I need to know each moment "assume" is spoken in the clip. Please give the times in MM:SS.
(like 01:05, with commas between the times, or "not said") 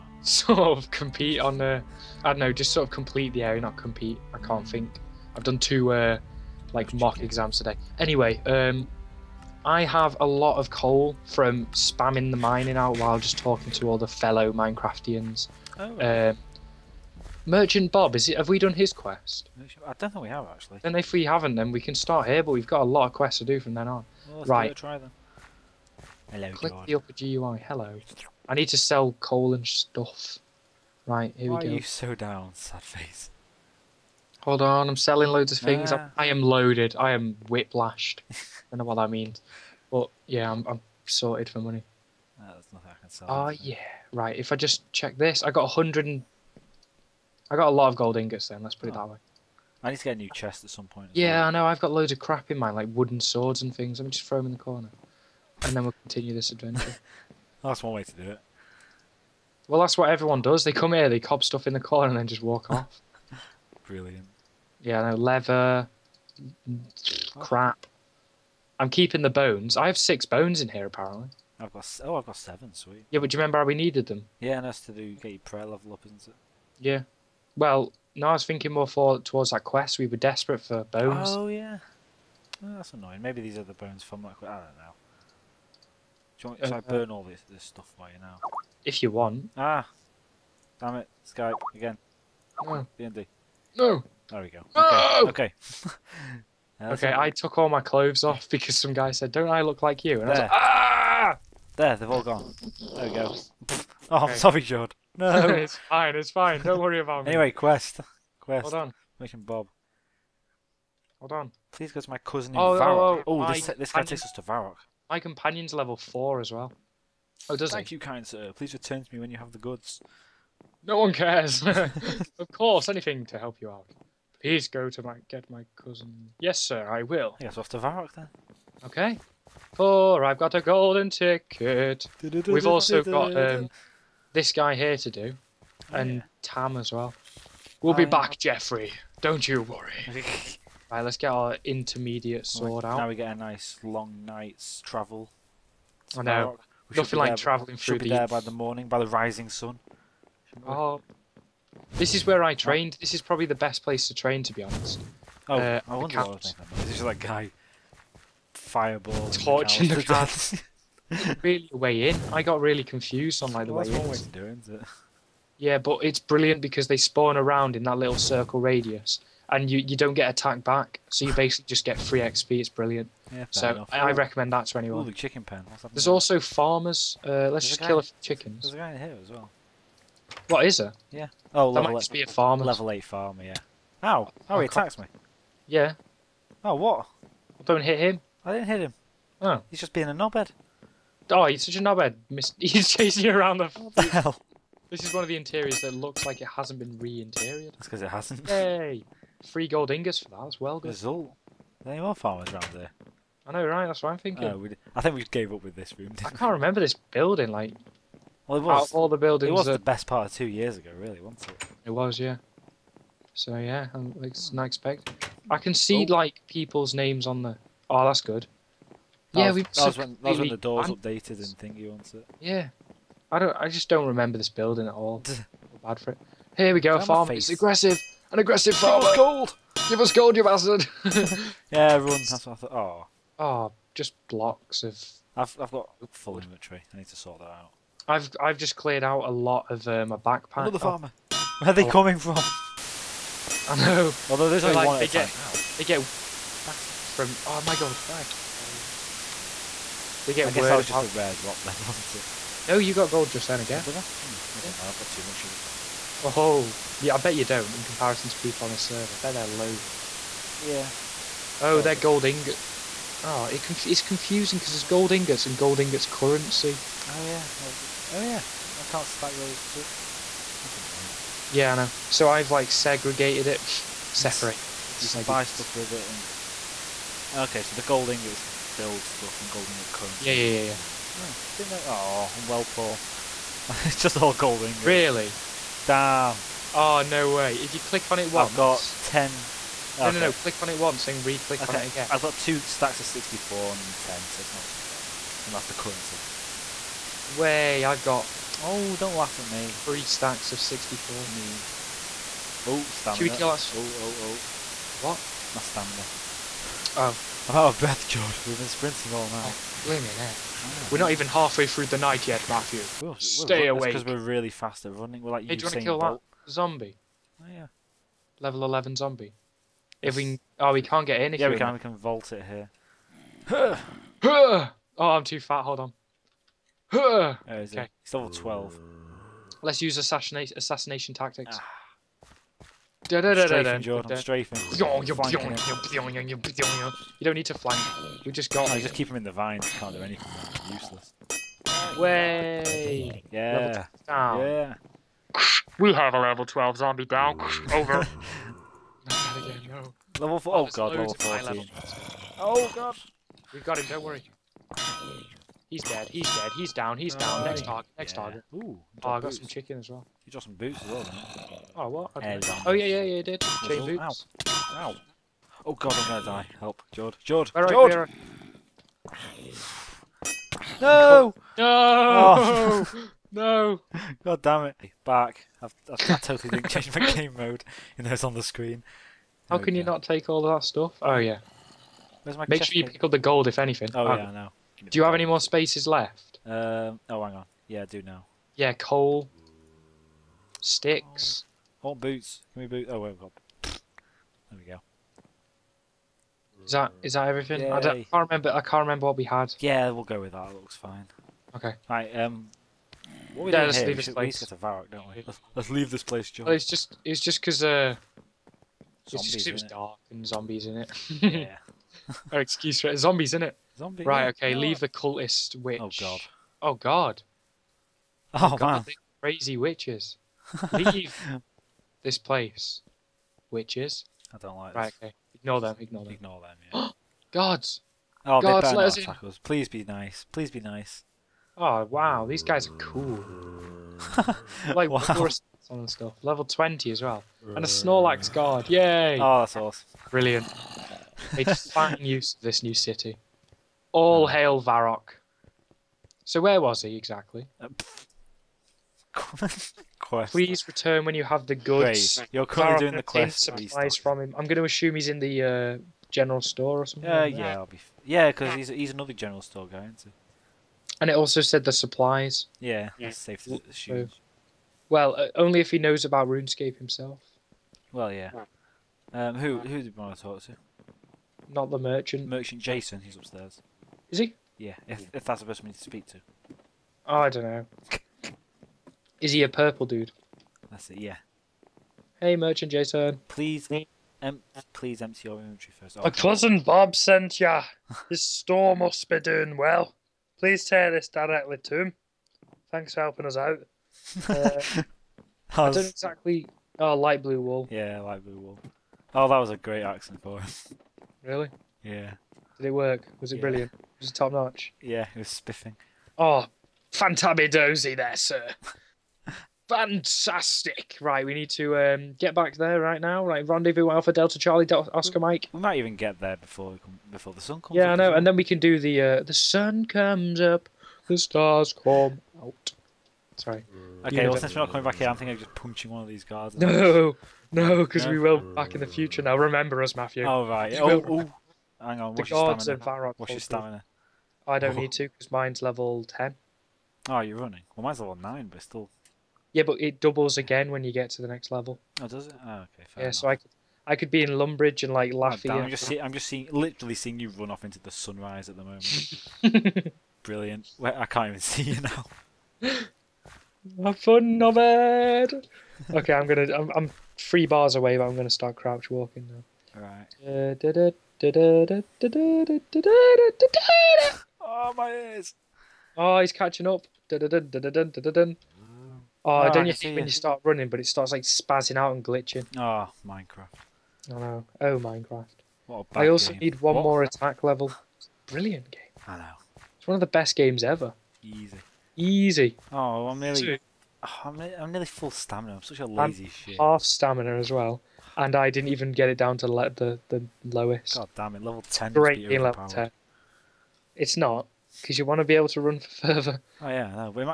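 07:34, 07:43.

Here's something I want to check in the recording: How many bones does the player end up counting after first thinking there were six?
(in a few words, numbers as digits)
7.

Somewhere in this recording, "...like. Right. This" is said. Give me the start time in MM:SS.
07:04.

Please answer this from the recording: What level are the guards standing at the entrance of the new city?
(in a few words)
20.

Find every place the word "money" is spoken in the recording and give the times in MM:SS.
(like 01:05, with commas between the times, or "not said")
00:41, 04:40.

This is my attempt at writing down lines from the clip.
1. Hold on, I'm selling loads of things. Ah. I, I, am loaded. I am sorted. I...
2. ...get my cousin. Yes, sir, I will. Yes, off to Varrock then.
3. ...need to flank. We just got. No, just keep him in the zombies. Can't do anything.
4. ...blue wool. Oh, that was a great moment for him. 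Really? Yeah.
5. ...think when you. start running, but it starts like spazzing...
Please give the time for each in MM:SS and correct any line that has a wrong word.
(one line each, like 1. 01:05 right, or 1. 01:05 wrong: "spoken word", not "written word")
1. 00:34 wrong: "whiplashed", not "sorted"
2. 02:05 right
3. 05:37 wrong: "vines", not "zombies"
4. 08:18 wrong: "accent", not "moment"
5. 09:29 right.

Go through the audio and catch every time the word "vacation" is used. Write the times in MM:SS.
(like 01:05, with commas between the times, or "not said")
not said.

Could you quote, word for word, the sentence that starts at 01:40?
I was like, "Ah!" There, they've all gone.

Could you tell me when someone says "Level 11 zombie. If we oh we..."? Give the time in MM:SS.
05:18.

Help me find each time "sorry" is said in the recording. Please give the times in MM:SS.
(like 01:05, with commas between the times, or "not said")
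01:44, 08:43.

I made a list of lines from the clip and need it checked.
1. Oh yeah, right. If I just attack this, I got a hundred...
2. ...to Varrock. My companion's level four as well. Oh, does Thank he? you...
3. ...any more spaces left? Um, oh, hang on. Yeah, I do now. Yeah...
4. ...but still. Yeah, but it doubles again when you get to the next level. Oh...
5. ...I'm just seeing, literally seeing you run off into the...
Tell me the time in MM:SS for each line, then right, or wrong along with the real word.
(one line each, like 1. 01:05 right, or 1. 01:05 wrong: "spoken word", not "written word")
1. 00:43 wrong: "check", not "attack"
2. 01:54 right
3. 06:25 right
4. 08:58 right
5. 09:05 right.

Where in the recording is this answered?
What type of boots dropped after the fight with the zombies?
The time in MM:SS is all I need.
06:03.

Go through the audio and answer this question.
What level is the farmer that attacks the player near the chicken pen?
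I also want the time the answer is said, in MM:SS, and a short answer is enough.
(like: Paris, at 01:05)
8, at 03:02.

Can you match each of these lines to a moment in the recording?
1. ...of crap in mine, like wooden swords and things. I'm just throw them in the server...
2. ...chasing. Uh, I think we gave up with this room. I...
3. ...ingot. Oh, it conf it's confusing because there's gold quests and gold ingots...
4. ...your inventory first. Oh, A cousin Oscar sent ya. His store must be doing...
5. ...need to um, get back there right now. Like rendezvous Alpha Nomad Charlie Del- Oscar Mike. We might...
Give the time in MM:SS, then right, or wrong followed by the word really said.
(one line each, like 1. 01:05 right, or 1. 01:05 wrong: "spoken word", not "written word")
1. 00:52 wrong: "corner", not "server"
2. 03:24 wrong: "thinking", not "chasing"
3. 04:22 wrong: "ingots", not "quests"
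4. 08:05 wrong: "Bob", not "Oscar"
5. 08:31 wrong: "Delta", not "Nomad".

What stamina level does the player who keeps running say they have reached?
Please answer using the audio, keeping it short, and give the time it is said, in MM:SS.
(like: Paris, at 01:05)
10, at 08:55.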